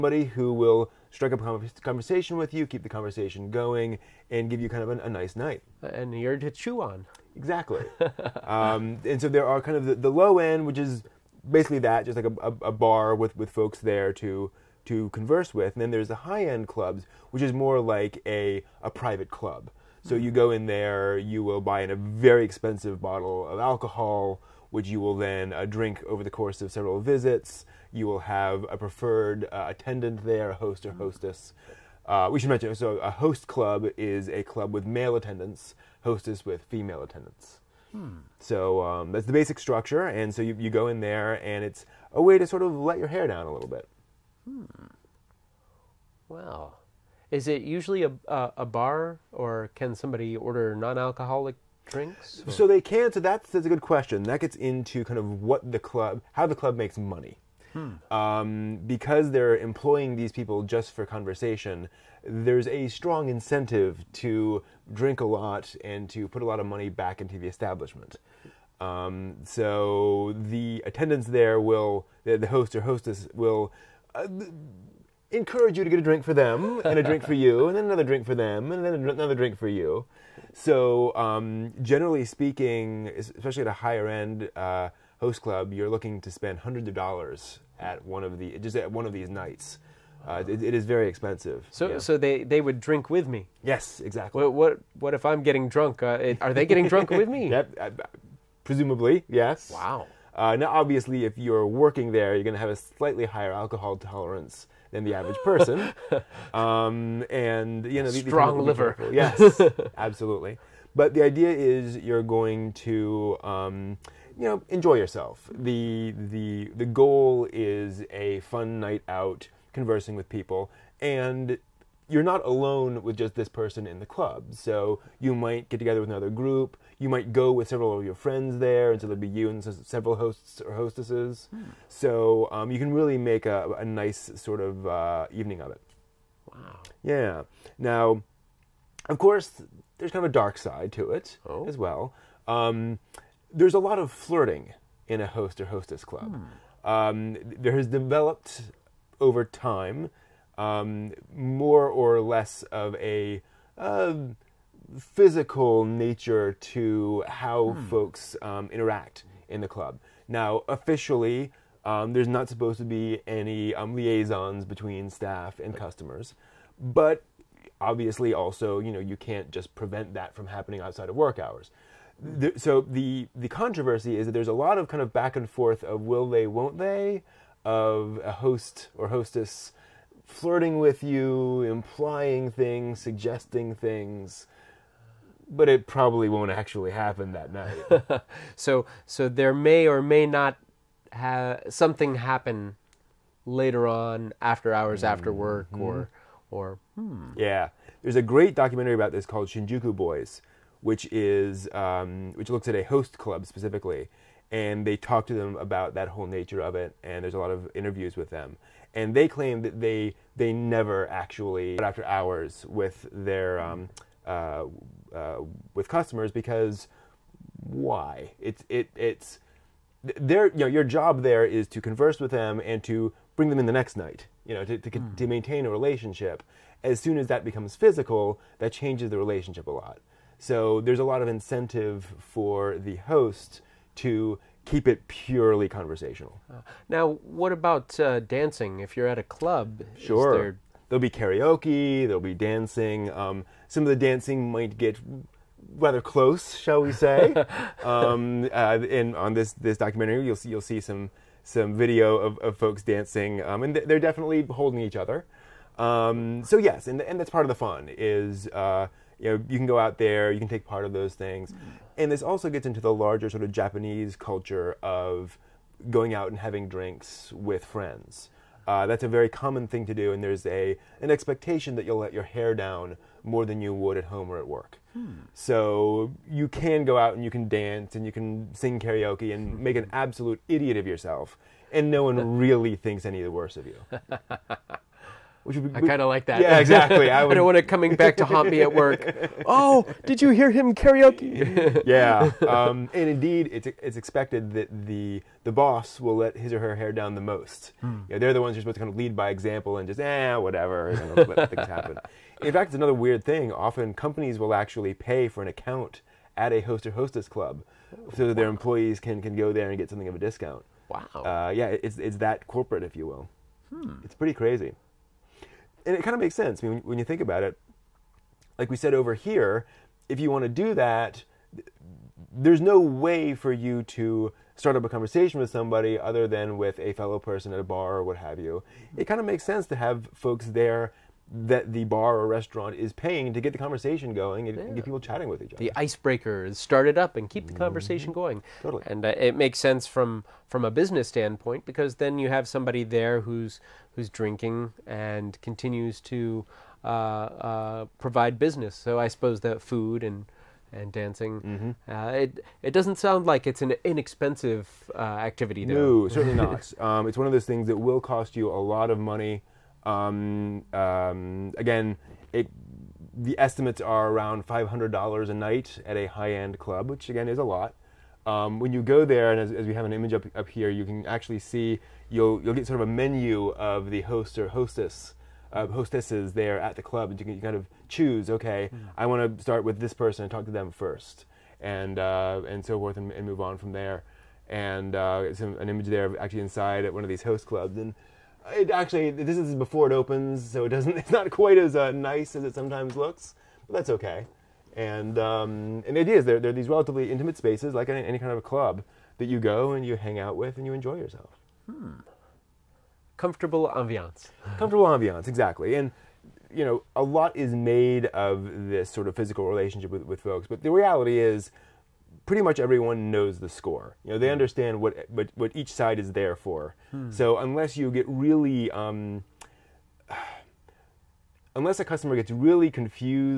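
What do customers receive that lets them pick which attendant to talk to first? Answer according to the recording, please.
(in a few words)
a menu.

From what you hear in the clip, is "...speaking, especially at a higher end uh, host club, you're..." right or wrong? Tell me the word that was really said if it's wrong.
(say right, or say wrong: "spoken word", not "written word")
right.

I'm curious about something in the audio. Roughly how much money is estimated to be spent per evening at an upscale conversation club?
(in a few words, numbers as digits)
$500.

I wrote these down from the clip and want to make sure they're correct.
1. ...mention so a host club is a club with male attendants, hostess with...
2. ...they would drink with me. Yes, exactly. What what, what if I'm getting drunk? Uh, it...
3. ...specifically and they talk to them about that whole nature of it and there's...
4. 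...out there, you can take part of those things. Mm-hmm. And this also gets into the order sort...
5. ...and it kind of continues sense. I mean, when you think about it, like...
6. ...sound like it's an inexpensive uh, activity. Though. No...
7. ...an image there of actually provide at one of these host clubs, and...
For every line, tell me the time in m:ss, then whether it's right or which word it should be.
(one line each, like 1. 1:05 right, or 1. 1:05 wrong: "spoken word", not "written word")
1. 0:32 right
2. 1:32 right
3. 3:23 right
4. 4:19 wrong: "larger", not "order"
5. 5:15 wrong: "makes", not "continues"
6. 5:52 right
7. 6:25 wrong: "inside", not "provide".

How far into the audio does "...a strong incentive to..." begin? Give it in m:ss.
1:02.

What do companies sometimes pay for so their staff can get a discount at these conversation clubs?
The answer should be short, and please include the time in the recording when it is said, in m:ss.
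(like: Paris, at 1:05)
an account, at 5:05.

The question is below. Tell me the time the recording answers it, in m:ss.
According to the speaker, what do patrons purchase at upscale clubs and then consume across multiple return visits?
0:22.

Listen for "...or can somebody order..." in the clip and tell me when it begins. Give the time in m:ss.
0:49.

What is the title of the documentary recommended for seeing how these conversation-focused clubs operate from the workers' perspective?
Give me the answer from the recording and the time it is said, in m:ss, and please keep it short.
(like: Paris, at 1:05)
Shinjuku Boys, at 3:19.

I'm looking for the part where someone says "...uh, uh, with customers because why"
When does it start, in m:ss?
3:34.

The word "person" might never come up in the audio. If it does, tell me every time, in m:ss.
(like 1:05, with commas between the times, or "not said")
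1:45, 2:03, 5:27, 6:19.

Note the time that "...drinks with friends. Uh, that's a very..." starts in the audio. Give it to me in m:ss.
4:26.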